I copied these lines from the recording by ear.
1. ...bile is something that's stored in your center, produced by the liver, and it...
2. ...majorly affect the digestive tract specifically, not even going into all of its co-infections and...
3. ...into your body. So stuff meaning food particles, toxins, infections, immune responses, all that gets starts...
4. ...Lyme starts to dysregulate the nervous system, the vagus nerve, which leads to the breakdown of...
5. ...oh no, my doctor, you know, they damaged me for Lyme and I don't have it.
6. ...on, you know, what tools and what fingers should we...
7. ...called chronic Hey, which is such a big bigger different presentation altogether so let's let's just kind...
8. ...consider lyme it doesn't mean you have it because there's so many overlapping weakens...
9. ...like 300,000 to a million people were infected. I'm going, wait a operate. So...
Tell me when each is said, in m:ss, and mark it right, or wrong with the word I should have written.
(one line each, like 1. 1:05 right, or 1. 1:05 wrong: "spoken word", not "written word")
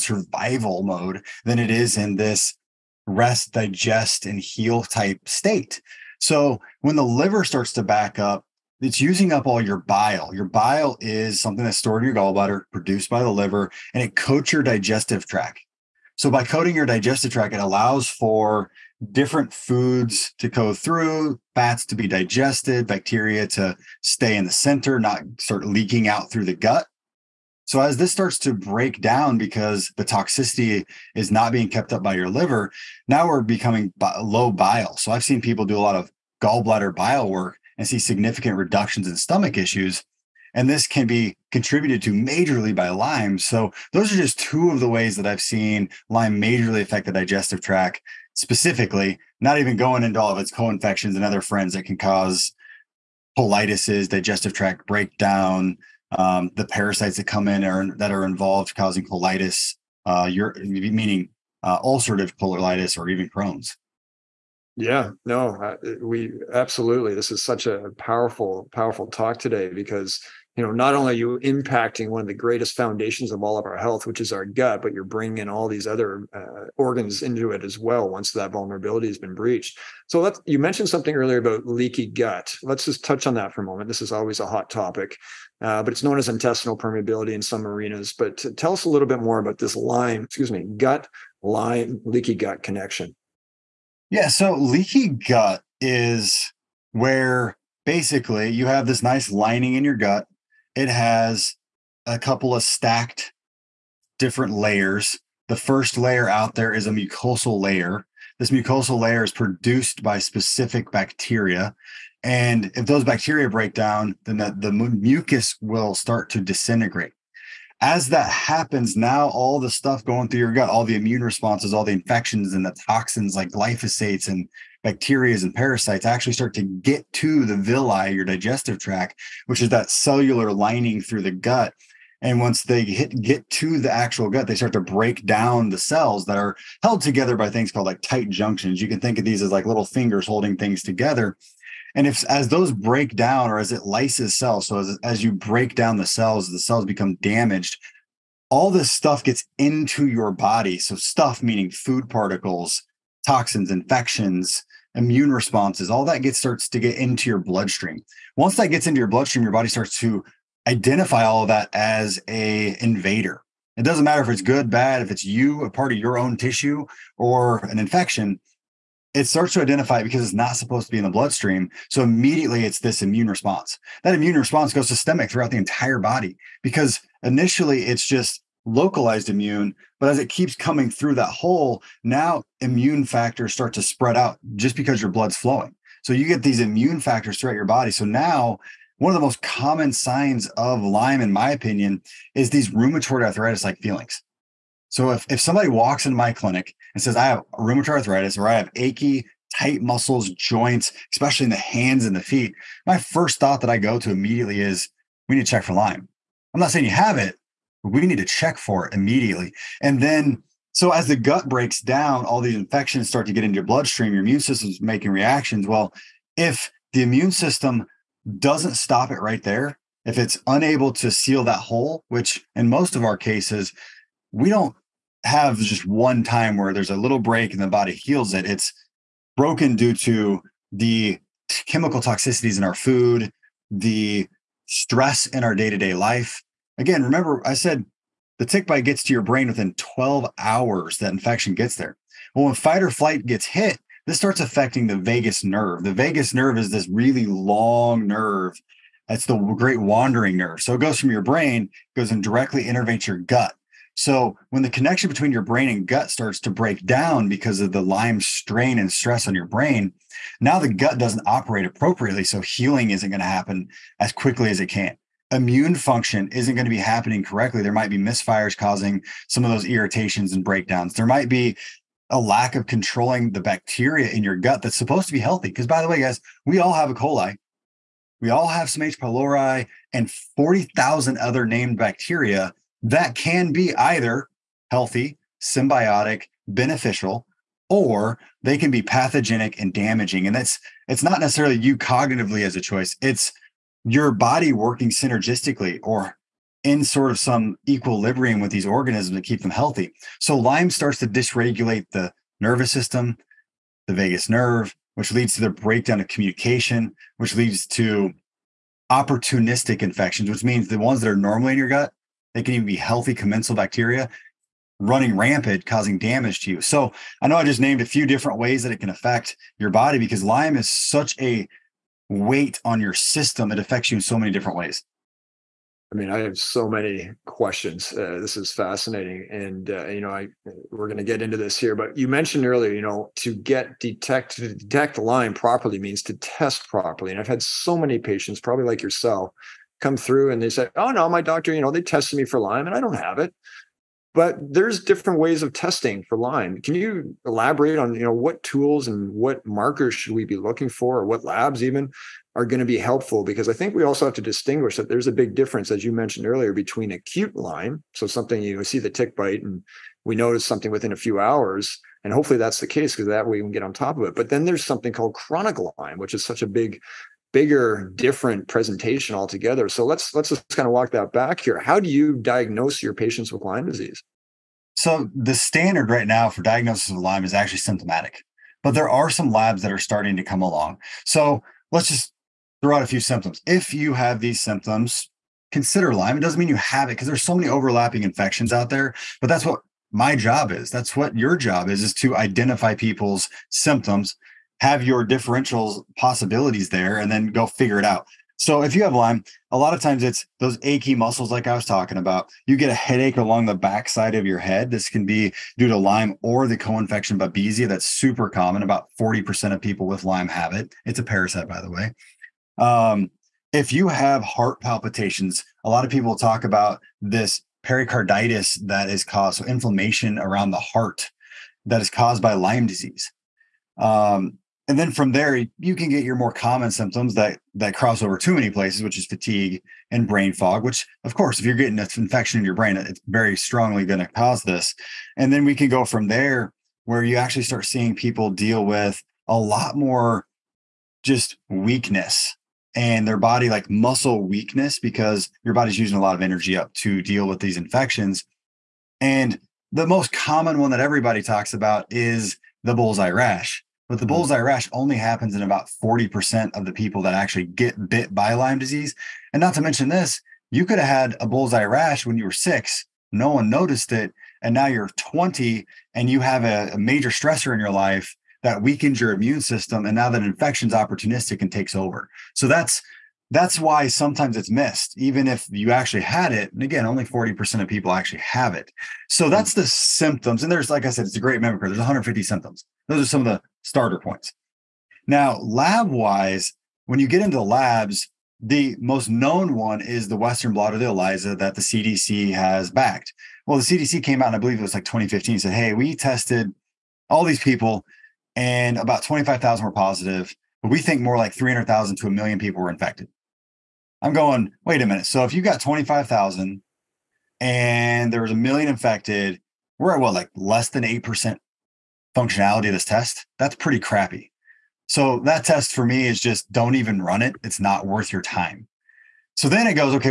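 1. 0:10 wrong: "gallbladder", not "center"
2. 0:46 right
3. 2:29 right
4. 5:00 right
5. 5:40 wrong: "tested", not "damaged"
6. 5:47 wrong: "markers", not "fingers"
7. 6:04 wrong: "Lyme", not "Hey"
8. 6:25 wrong: "infections", not "weakens"
9. 8:21 wrong: "minute", not "operate".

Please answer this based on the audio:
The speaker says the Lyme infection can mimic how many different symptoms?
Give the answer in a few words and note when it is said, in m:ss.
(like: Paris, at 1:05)
150, at 8:01.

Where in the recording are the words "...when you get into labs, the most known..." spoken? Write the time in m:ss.
8:06.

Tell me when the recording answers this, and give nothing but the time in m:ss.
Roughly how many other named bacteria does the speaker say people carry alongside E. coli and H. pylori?
4:40.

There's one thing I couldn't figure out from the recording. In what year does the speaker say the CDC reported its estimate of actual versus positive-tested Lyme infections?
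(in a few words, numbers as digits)
2015.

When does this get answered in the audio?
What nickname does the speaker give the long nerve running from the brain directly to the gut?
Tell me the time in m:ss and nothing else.
4:09.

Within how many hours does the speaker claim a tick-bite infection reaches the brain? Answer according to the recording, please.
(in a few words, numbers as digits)
12.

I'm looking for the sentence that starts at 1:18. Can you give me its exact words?
Once that vulnerability has been breached, so let's.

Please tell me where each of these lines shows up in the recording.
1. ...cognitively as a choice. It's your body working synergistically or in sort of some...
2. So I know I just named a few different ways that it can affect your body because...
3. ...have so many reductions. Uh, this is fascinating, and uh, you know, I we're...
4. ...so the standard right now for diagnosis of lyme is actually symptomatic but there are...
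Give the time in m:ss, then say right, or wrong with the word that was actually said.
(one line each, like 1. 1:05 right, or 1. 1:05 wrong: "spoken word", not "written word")
1. 4:51 right
2. 5:16 right
3. 5:26 wrong: "questions", not "reductions"
4. 6:14 right.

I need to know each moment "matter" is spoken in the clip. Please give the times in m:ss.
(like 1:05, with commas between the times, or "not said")
2:44.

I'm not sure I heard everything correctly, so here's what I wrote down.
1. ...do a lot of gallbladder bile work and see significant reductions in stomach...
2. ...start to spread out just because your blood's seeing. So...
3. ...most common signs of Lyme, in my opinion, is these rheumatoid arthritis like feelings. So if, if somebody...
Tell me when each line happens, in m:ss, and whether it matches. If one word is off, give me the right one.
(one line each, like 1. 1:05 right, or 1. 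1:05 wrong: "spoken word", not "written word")
1. 0:35 right
2. 3:03 wrong: "flowing", not "seeing"
3. 3:09 right.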